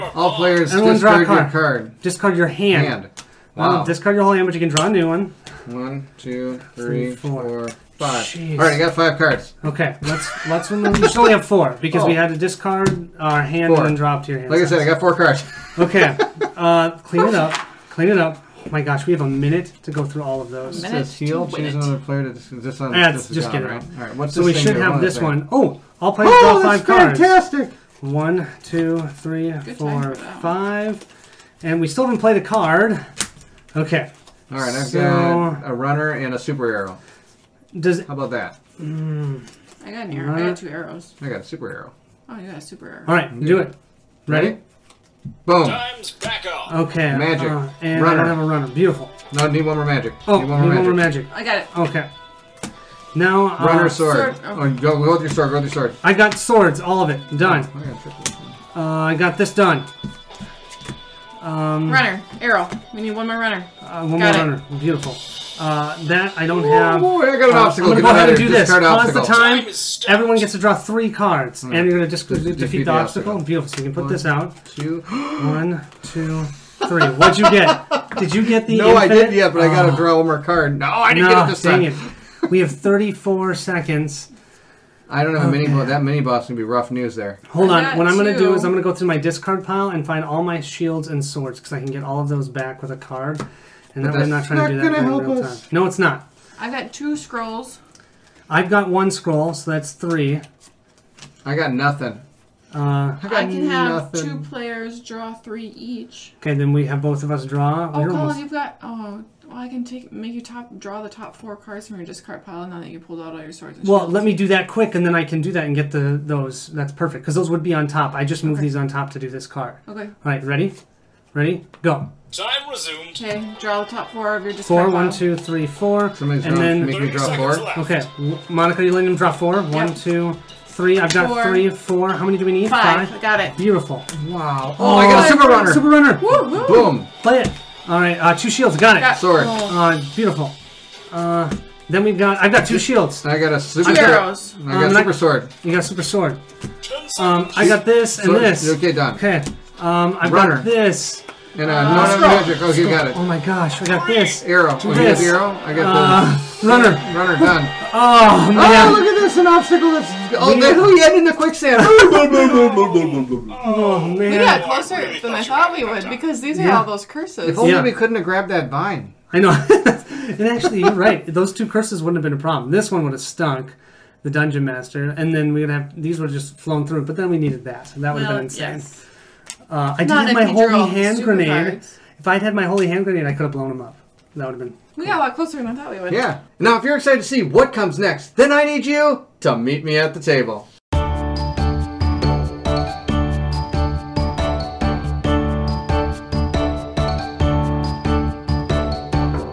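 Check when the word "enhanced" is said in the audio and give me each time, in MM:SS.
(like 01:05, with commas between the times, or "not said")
not said.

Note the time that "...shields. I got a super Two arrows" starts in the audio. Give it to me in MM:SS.
02:22.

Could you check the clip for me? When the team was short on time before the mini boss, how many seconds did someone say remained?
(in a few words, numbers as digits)
34.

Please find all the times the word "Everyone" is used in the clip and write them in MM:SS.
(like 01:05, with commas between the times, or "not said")
00:00, 01:10.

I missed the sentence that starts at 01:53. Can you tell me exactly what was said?
well, let me do that quick, and then I can do that and get the those.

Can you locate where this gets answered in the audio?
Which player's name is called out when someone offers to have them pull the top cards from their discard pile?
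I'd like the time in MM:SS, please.
01:47.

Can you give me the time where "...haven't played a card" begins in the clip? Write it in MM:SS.
00:32.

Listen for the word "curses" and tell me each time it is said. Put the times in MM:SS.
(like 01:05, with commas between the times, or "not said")
02:47, 02:51.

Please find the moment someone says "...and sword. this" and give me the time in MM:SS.
02:28.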